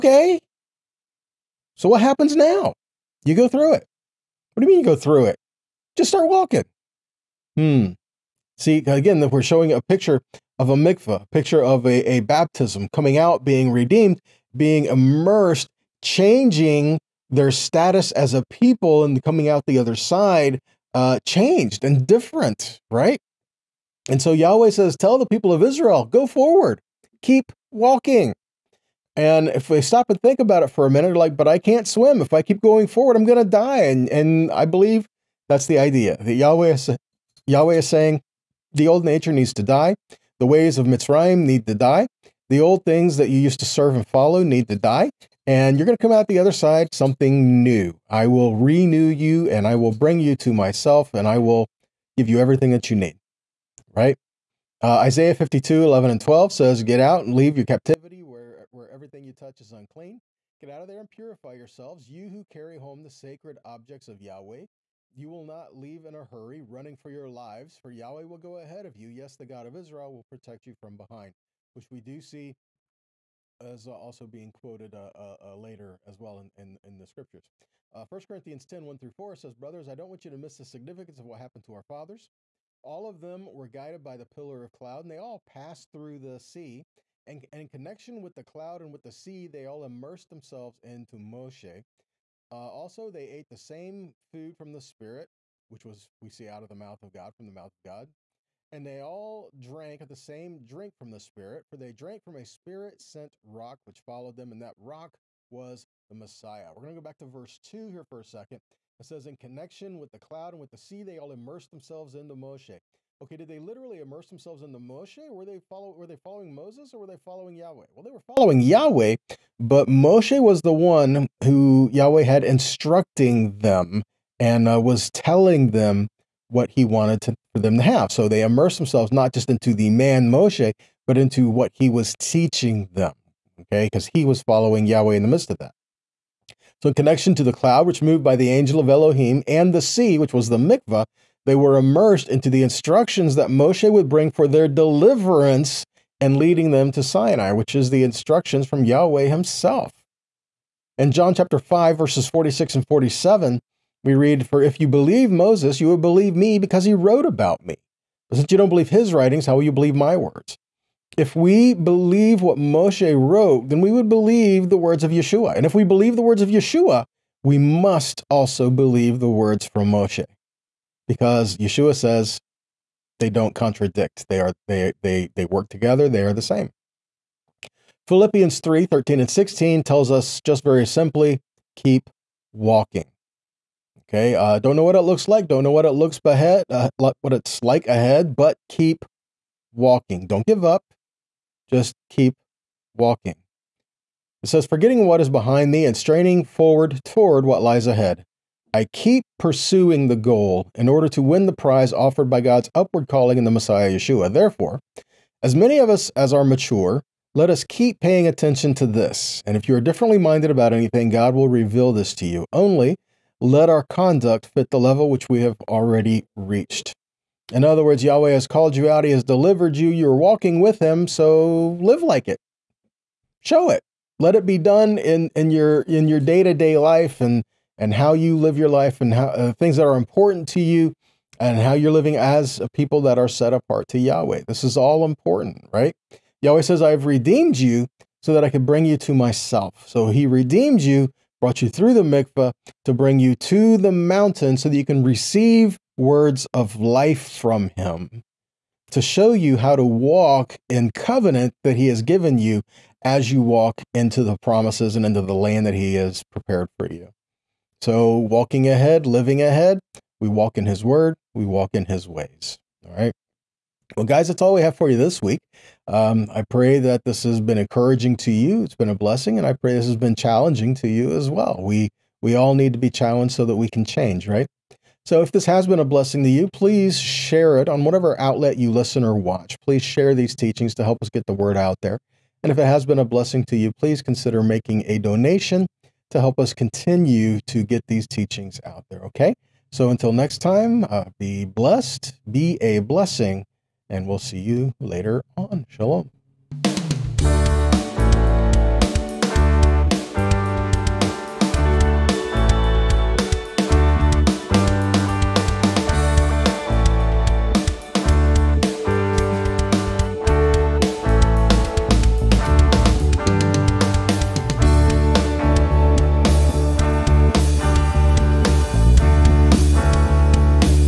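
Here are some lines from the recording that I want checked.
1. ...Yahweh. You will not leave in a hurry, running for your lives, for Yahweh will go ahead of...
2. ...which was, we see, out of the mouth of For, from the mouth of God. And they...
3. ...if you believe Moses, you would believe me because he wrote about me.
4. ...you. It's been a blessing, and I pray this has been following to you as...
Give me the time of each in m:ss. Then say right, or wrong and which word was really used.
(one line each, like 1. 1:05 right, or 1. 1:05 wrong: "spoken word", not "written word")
1. 1:04 right
2. 1:35 wrong: "God", not "For"
3. 2:34 right
4. 4:28 wrong: "challenging", not "following".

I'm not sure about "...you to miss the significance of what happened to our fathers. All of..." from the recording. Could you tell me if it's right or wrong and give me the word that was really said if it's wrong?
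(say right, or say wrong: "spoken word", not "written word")
right.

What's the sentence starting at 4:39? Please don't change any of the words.
Please share these teachings to help us get the word out there.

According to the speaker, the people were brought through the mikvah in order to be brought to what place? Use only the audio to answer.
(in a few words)
the mountain.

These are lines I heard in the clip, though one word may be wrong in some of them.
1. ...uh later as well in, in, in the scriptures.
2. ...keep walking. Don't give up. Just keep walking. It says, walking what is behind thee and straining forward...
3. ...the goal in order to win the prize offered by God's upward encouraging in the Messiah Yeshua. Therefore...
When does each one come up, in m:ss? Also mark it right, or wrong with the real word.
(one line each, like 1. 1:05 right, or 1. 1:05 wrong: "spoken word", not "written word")
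1. 1:15 right
2. 3:08 wrong: "forgetting", not "walking"
3. 3:20 wrong: "calling", not "encouraging".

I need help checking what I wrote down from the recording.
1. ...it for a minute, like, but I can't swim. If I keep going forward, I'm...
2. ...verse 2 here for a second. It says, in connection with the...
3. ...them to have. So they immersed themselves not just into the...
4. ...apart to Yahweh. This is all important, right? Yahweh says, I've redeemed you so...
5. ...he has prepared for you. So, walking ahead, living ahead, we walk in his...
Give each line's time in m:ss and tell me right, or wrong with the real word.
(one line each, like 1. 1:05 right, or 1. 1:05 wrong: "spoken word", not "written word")
1. 0:30 right
2. 1:47 right
3. 2:07 right
4. 3:53 right
5. 4:15 right.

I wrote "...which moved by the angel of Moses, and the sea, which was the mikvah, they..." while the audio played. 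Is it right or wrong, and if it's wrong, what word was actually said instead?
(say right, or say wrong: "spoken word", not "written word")
wrong: "Elohim", not "Moses".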